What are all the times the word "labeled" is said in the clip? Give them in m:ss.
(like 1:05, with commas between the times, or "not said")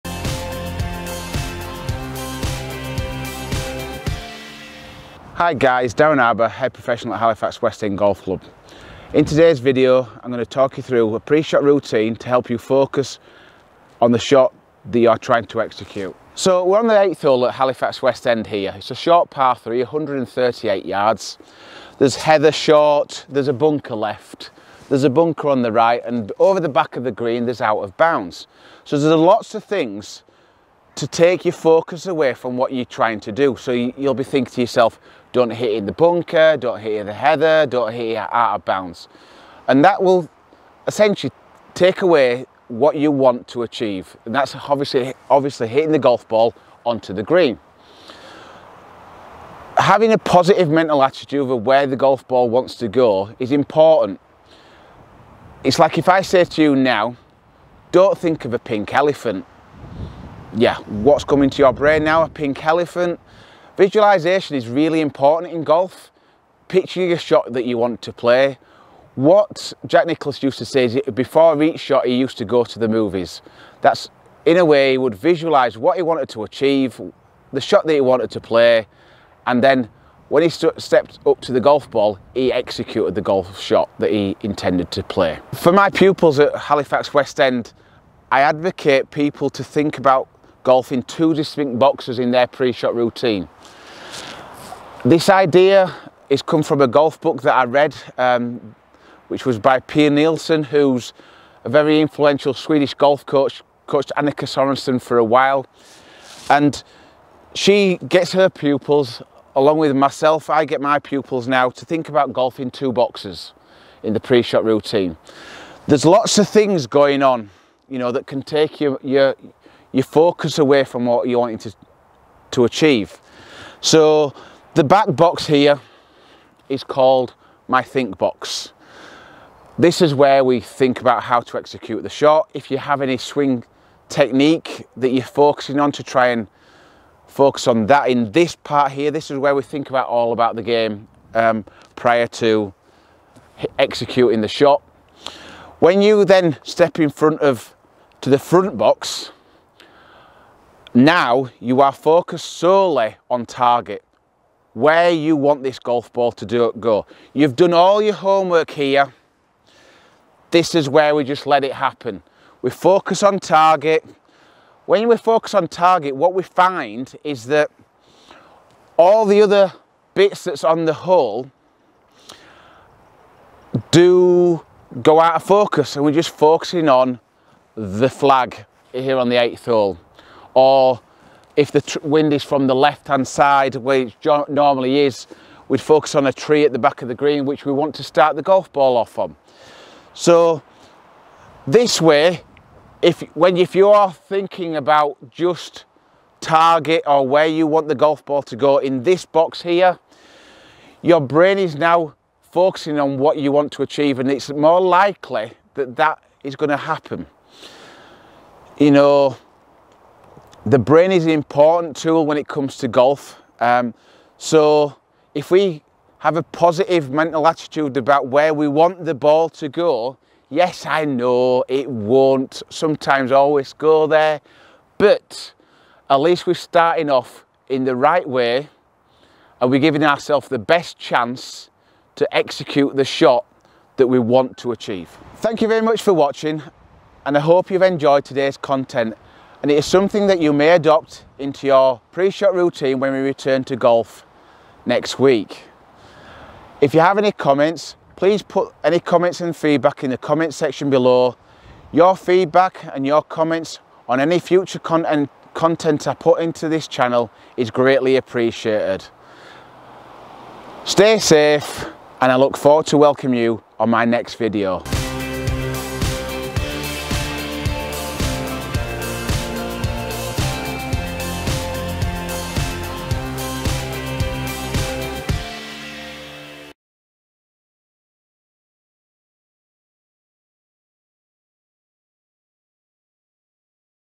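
not said.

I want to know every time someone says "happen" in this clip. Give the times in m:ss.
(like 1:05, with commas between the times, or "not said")
2:41, 3:26.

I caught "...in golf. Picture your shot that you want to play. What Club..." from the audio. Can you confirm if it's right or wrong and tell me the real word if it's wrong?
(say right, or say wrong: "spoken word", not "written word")
wrong: "Jack", not "Club".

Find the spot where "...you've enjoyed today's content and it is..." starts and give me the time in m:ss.
3:57.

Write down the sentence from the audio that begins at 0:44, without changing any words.
And that's obviously, obviously hitting the golf ball onto the green.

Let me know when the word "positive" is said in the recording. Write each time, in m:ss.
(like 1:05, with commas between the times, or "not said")
0:50, 3:36.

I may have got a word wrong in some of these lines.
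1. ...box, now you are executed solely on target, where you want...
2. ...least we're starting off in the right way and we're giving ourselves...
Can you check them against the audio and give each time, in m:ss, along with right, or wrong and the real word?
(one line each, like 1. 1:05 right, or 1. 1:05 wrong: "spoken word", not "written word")
1. 2:28 wrong: "focused", not "executed"
2. 3:46 right.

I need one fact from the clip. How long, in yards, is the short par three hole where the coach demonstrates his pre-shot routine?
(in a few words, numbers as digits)
138 yards.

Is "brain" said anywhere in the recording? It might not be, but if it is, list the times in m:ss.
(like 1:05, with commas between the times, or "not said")
1:01, 3:21, 3:30.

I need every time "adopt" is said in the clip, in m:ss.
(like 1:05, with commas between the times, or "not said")
4:00.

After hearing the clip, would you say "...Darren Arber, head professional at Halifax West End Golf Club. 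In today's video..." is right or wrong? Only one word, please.
right.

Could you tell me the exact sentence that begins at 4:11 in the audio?
Your feedback and your comments on any future content, content I put into this channel is greatly appreciated.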